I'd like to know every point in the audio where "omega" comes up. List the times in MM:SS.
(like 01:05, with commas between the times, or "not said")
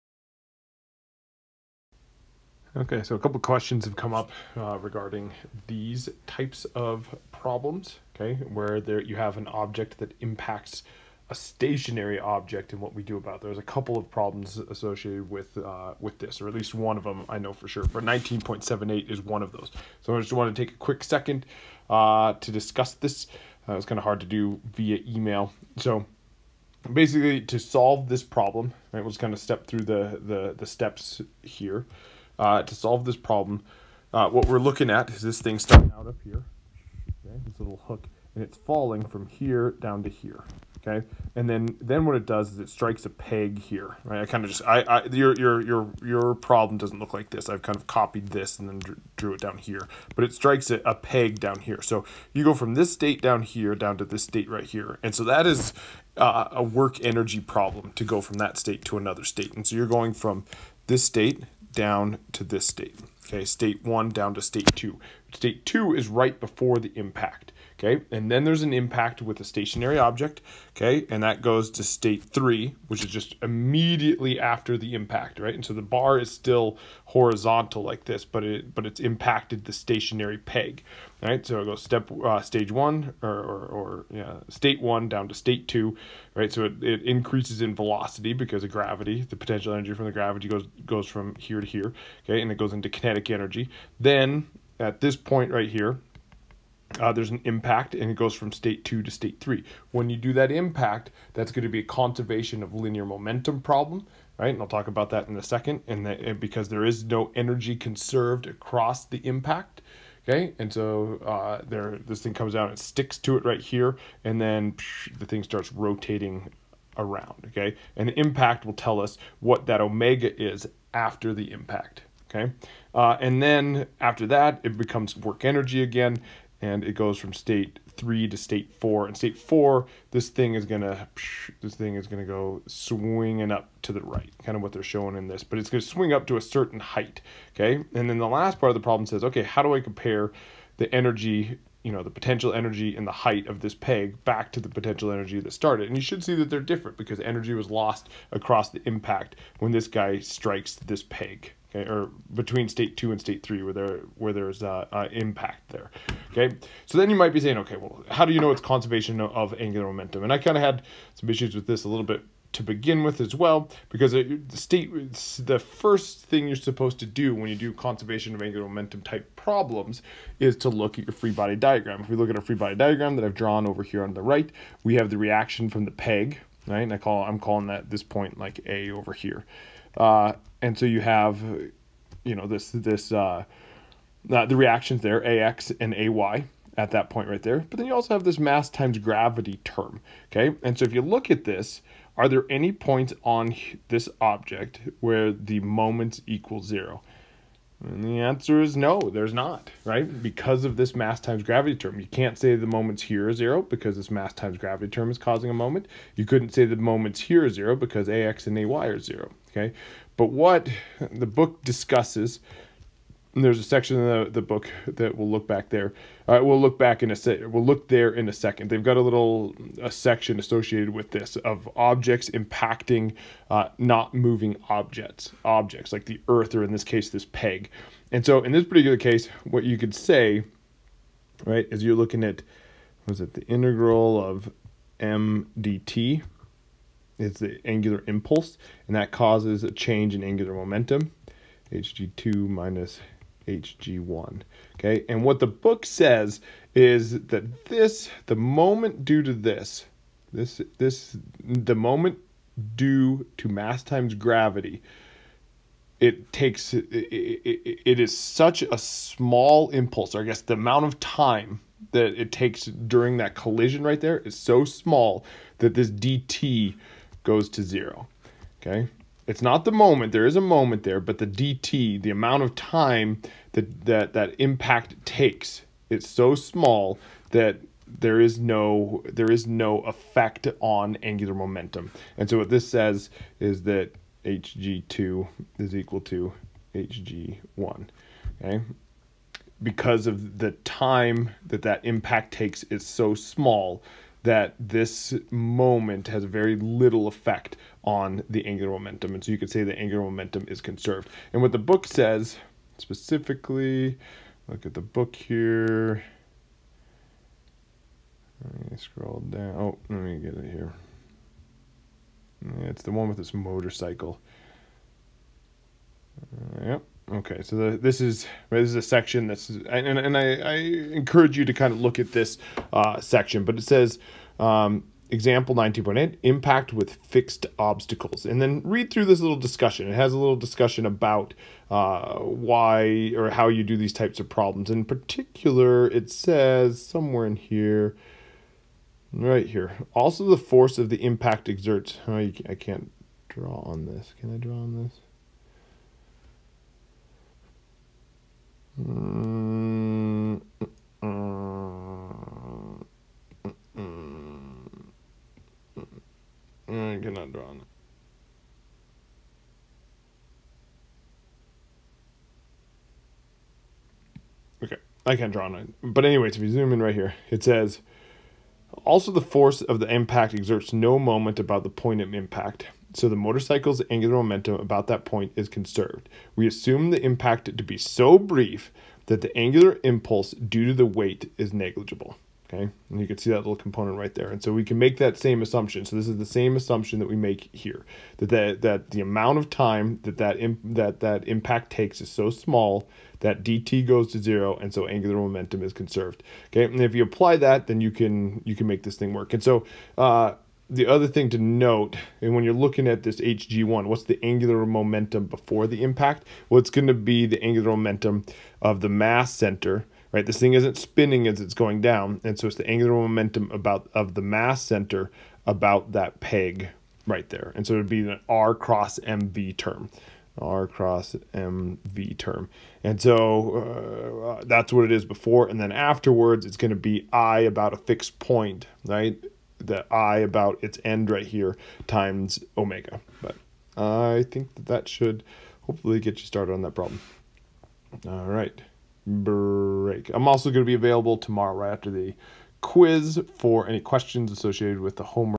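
01:59, 07:12.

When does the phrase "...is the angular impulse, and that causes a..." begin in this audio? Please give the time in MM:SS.
03:57.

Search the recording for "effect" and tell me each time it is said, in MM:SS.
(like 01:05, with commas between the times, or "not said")
04:39, 04:57.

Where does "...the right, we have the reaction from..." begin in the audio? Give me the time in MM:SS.
02:54.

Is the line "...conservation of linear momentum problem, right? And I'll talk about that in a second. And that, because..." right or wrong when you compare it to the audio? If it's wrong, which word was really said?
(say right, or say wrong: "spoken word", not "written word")
right.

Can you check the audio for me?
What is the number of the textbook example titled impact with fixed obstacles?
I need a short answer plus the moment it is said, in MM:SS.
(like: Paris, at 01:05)
19.8, at 05:25.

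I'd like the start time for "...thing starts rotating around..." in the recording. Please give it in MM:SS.
01:55.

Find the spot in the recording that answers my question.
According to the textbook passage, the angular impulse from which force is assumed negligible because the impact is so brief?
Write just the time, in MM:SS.
06:20.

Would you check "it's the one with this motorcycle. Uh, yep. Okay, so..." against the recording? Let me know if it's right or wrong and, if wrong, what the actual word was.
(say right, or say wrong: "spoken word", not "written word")
right.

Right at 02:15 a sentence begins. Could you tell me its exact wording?
But it's gonna swing up to a certain height.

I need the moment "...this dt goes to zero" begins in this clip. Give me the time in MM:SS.
04:25.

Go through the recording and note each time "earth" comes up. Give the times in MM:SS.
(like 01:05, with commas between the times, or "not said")
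03:46.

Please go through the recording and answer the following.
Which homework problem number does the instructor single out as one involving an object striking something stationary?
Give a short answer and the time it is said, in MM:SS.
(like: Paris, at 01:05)
19.78, at 00:18.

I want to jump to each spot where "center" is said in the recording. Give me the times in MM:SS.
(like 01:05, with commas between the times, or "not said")
06:49, 06:54.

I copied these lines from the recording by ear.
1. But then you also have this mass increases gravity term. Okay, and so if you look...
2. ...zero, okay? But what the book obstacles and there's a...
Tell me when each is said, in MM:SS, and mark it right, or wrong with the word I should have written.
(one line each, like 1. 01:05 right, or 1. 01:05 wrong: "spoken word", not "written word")
1. 03:07 wrong: "times", not "increases"
2. 03:28 wrong: "discusses", not "obstacles".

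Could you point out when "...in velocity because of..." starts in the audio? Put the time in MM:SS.
01:27.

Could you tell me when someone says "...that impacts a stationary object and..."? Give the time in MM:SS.
00:09.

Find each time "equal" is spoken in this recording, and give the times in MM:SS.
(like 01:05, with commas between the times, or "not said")
03:16, 04:45.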